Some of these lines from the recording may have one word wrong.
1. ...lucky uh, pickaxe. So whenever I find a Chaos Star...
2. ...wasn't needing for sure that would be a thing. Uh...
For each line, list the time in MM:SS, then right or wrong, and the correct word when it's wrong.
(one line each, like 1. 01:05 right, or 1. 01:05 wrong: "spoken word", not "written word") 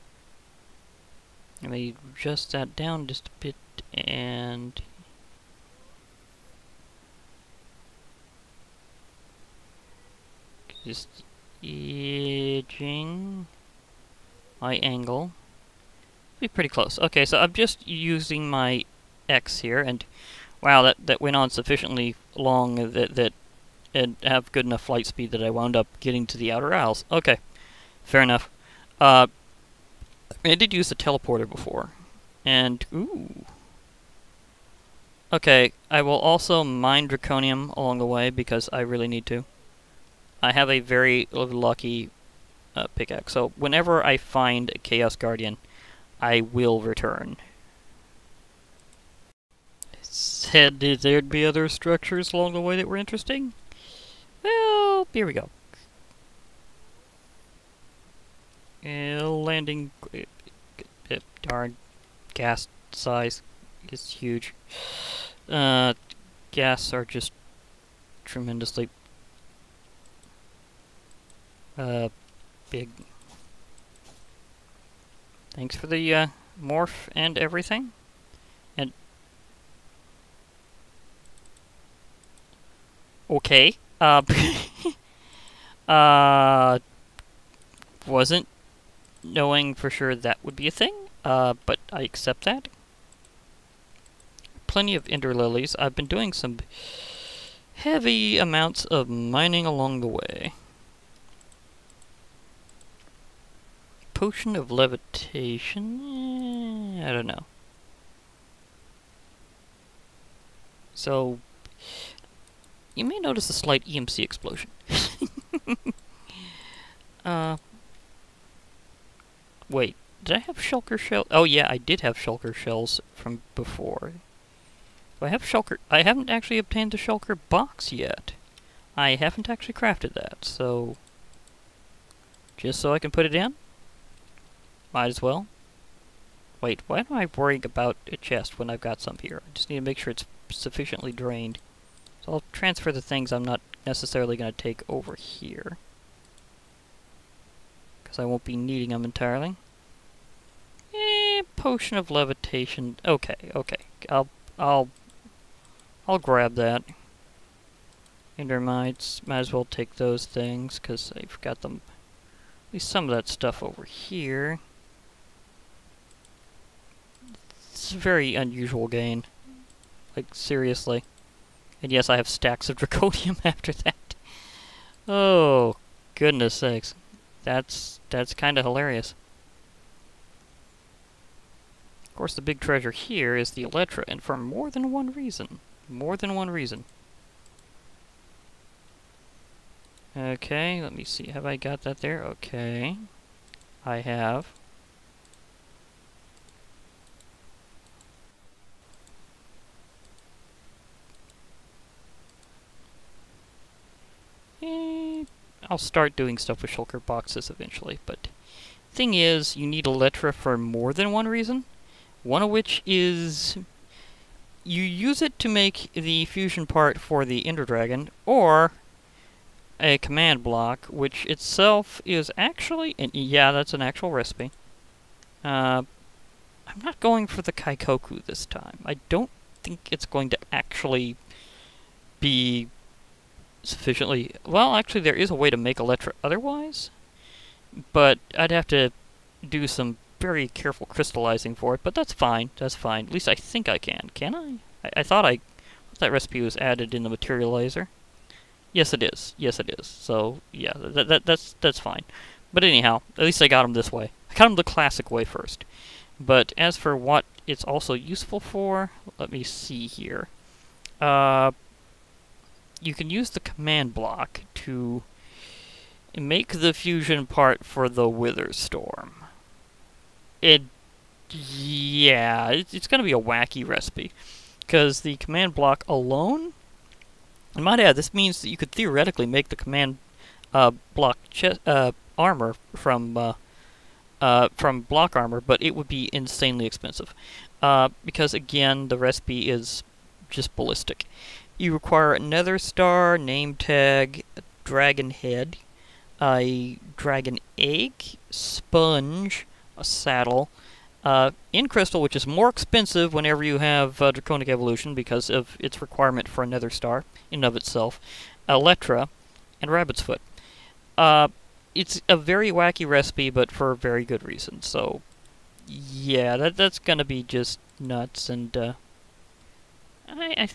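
1. 00:41 wrong: "Guardian", not "Star"
2. 01:28 wrong: "knowing", not "needing".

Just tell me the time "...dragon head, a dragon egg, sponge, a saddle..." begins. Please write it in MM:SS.
04:54.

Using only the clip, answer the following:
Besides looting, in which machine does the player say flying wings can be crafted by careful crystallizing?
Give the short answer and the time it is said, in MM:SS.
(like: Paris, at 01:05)
the materializer, at 04:07.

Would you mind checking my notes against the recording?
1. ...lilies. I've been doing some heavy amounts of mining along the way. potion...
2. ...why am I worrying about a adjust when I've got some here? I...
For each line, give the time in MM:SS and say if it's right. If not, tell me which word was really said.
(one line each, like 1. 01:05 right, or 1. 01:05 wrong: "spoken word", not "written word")
1. 01:35 right
2. 02:16 wrong: "chest", not "adjust".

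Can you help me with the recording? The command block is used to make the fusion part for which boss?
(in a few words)
the Wither Storm.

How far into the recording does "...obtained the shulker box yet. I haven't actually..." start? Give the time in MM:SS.
02:06.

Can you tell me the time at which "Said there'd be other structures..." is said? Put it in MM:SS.
00:50.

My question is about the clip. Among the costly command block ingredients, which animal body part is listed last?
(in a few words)
rabbit's foot.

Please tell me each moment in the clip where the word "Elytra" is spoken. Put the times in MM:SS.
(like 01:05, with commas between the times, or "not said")
03:03, 03:29, 03:55, 05:08.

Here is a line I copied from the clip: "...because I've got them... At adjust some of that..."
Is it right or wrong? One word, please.
wrong.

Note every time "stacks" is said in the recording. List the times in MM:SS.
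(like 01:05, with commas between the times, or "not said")
02:52.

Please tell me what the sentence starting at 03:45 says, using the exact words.
Uh, I'm not going for the Kaikoku this time.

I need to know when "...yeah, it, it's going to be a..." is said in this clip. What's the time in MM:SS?
04:31.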